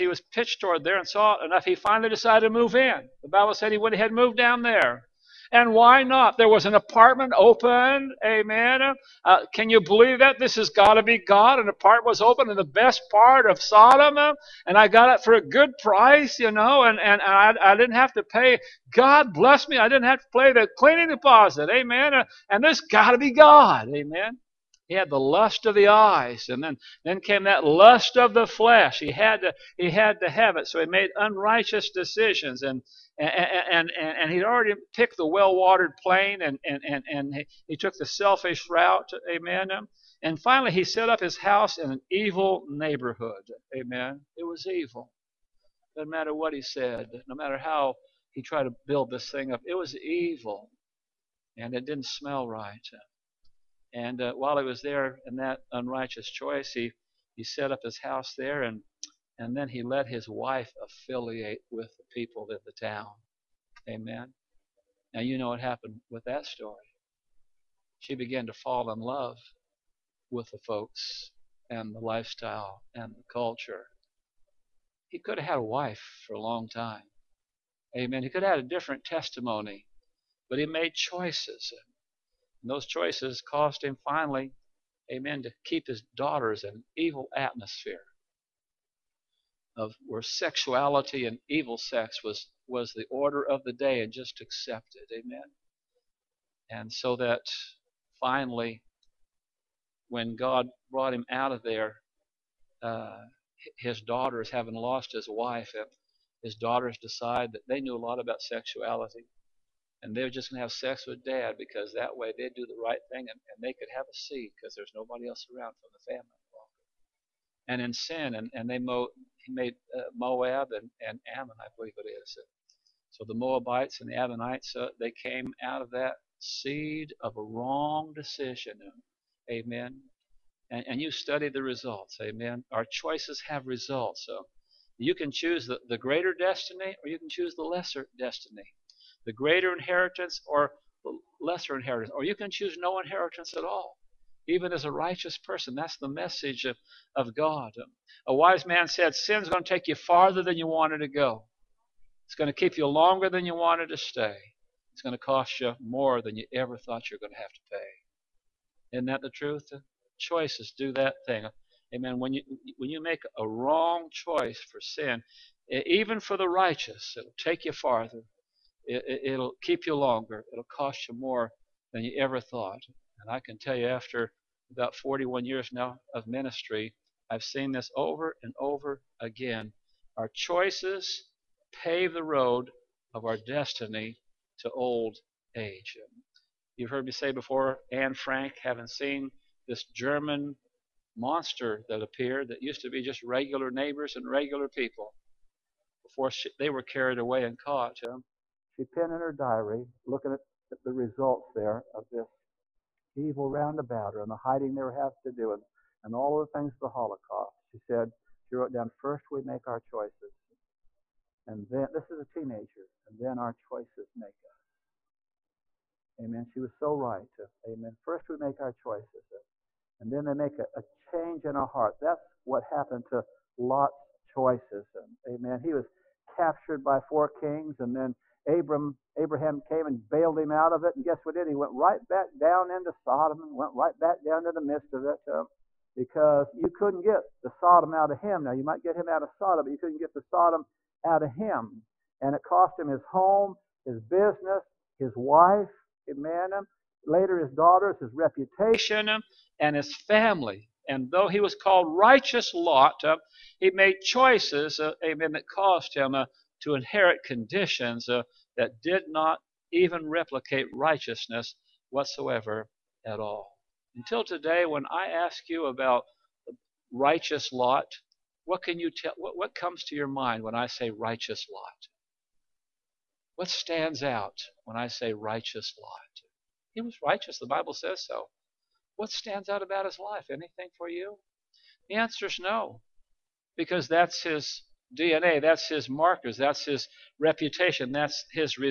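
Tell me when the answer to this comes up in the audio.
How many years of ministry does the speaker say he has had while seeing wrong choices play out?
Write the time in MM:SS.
02:54.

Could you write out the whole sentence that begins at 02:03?
So the Moabites and the Ammonites, uh, they came out of that seed of a wrong decision.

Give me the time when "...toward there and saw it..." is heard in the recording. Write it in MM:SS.
00:00.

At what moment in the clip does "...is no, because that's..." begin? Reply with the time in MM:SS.
04:42.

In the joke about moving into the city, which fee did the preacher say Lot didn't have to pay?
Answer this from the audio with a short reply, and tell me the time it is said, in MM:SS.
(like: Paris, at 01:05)
cleaning deposit, at 00:20.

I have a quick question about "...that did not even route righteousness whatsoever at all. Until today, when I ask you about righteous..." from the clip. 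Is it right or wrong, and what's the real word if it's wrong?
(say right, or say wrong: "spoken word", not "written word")
wrong: "replicate", not "route".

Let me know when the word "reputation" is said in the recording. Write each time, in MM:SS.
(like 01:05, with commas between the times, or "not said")
04:08, 04:47.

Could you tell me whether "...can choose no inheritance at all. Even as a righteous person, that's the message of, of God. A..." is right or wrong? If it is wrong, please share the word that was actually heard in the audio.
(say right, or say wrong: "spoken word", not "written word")
right.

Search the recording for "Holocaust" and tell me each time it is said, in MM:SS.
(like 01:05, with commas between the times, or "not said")
03:26.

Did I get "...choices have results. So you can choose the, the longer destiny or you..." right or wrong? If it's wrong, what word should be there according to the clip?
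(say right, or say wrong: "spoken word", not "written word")
wrong: "greater", not "longer".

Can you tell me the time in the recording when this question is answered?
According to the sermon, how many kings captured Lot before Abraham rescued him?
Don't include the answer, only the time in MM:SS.
03:47.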